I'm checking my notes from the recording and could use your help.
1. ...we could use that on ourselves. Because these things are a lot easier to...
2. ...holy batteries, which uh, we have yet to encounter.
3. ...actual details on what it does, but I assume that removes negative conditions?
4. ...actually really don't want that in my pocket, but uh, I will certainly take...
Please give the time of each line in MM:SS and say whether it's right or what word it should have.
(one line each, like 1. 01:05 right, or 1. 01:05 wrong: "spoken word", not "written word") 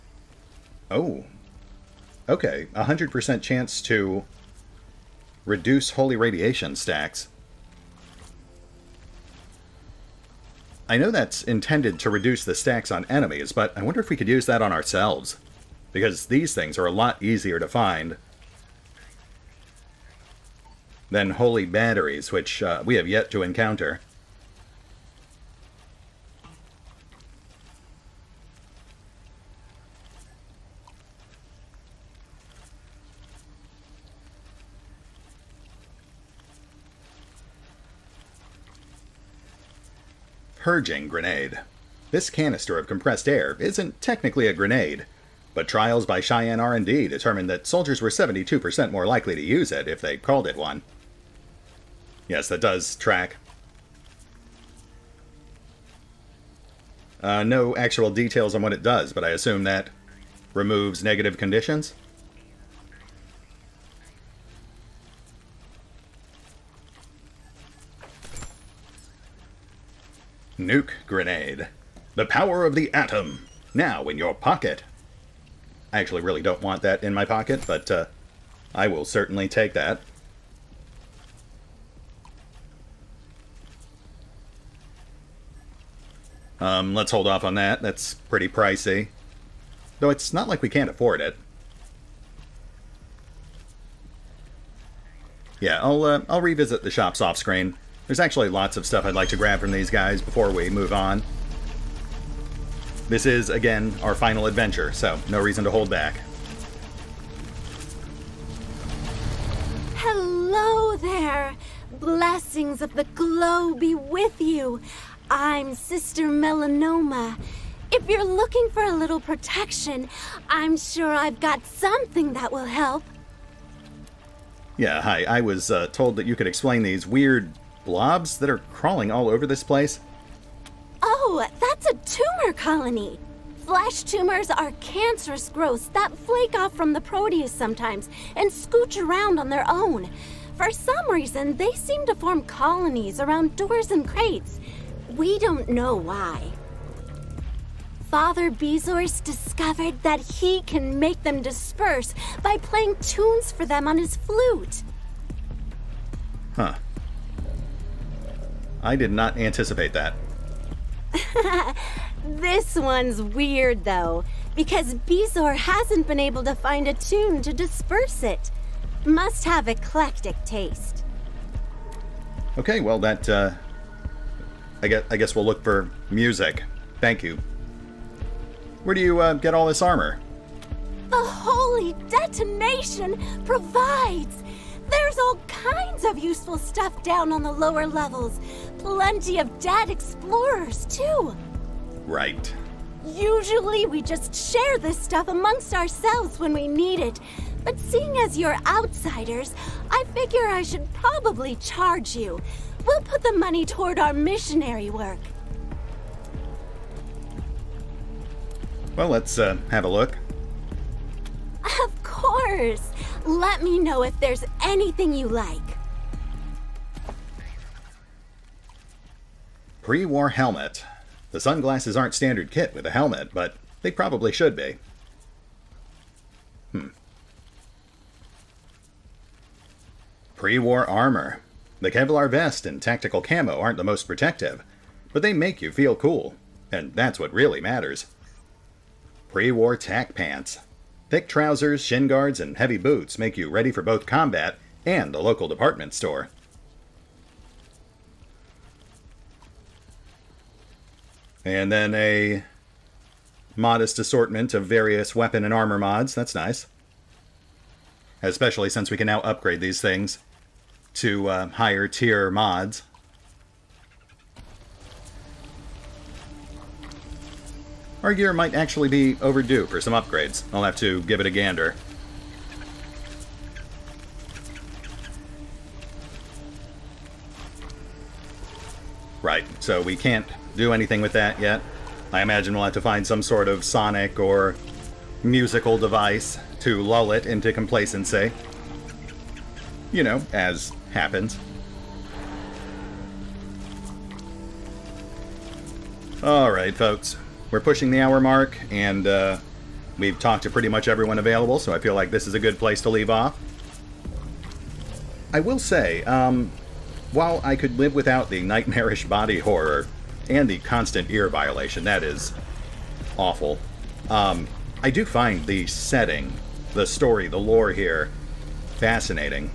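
1. 00:14 right
2. 00:21 right
3. 00:57 right
4. 01:15 right.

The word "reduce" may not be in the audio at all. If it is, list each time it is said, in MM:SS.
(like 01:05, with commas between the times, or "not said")
00:05, 00:12.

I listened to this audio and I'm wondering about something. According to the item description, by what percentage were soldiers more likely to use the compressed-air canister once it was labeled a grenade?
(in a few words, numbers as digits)
72%.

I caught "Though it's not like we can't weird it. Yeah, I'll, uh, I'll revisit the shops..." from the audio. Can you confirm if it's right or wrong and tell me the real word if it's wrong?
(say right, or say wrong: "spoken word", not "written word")
wrong: "afford", not "weird".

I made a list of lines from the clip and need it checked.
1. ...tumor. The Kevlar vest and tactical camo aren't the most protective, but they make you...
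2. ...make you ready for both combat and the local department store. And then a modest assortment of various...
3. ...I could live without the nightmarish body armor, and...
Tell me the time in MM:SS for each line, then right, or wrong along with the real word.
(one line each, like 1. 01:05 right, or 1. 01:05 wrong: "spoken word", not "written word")
1. 03:50 wrong: "armor", not "tumor"
2. 04:03 right
3. 05:07 wrong: "horror", not "armor".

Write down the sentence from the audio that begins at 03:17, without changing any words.
But seeing as you're outsiders, I figure I should probably charge you.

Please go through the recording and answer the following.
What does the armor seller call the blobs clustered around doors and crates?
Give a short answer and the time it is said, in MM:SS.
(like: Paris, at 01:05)
tumor colony, at 02:12.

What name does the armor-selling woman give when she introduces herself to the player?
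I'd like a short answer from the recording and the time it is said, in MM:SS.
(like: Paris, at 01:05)
Sister Melanoma, at 01:55.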